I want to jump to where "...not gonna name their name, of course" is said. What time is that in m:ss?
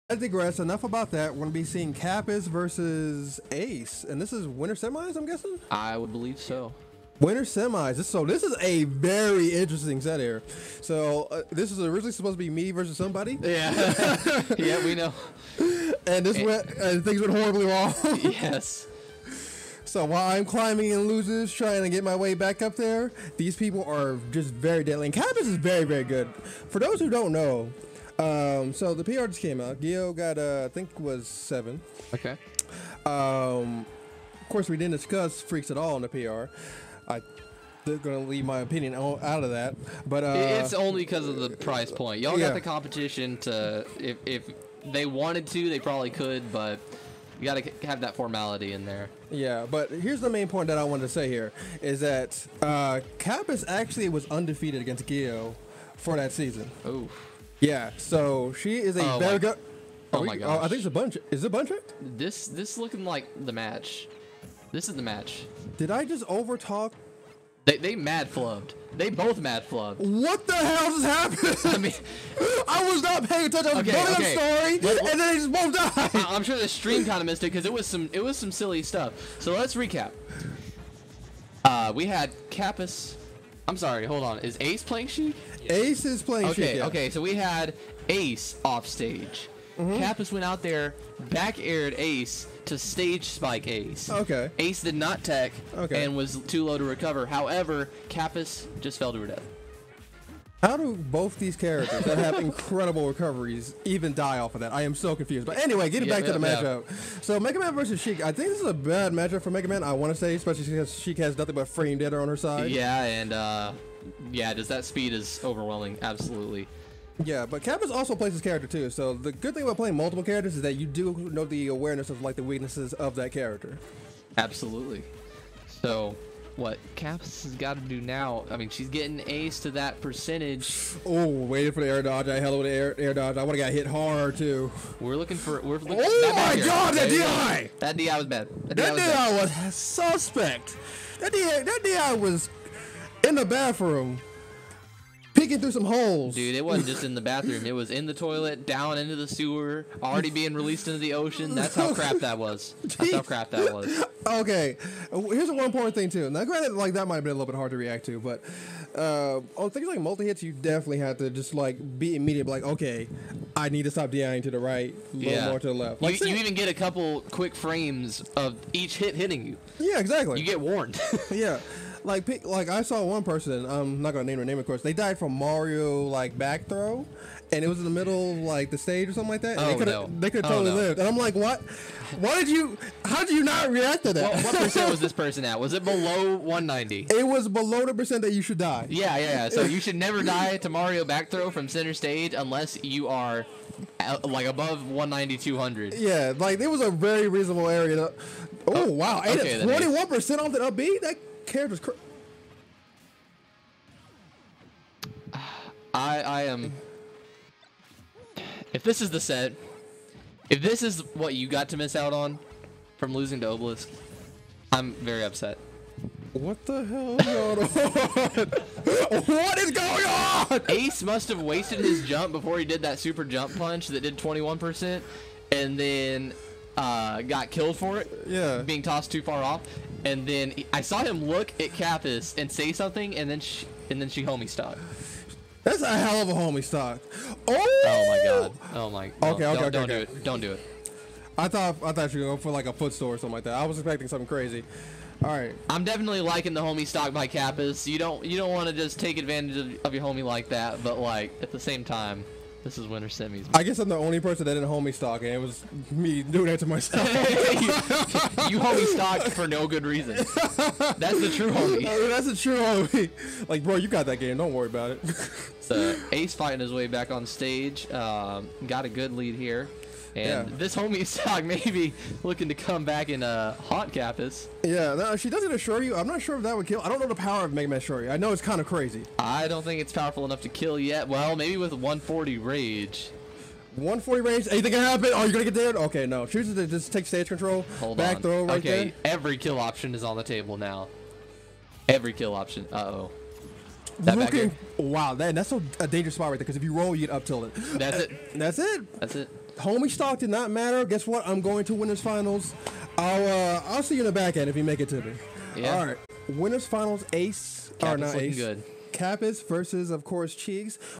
2:54.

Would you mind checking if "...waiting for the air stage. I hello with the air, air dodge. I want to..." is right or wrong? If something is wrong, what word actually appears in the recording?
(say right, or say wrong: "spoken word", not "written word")
wrong: "dodge", not "stage".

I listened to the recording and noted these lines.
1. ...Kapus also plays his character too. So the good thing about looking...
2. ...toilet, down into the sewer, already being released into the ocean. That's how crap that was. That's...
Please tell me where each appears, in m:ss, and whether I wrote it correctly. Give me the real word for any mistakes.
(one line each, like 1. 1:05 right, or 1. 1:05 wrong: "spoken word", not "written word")
1. 1:57 wrong: "playing", not "looking"
2. 2:28 right.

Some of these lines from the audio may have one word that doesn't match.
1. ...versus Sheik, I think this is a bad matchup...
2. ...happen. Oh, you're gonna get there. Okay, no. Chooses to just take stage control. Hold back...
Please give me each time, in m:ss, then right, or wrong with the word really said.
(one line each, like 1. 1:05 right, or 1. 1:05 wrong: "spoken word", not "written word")
1. 1:47 right
2. 4:44 right.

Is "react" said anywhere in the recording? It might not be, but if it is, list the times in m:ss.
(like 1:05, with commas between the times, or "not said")
2:37, 3:03.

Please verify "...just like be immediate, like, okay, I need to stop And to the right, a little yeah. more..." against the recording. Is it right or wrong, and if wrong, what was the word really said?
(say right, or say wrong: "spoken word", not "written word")
wrong: "DIing", not "And".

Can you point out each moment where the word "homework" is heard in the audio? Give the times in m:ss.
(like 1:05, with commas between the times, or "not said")
not said.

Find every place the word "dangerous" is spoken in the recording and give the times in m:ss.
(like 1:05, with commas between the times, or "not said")
4:55.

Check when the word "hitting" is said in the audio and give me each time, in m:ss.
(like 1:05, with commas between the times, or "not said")
2:49.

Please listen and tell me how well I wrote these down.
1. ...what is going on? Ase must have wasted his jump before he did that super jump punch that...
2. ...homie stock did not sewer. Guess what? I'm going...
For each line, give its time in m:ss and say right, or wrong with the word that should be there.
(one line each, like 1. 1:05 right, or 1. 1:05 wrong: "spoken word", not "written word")
1. 3:39 right
2. 4:59 wrong: "matter", not "sewer".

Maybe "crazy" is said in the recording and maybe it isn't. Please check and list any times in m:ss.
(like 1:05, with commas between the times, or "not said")
4:04, 4:38.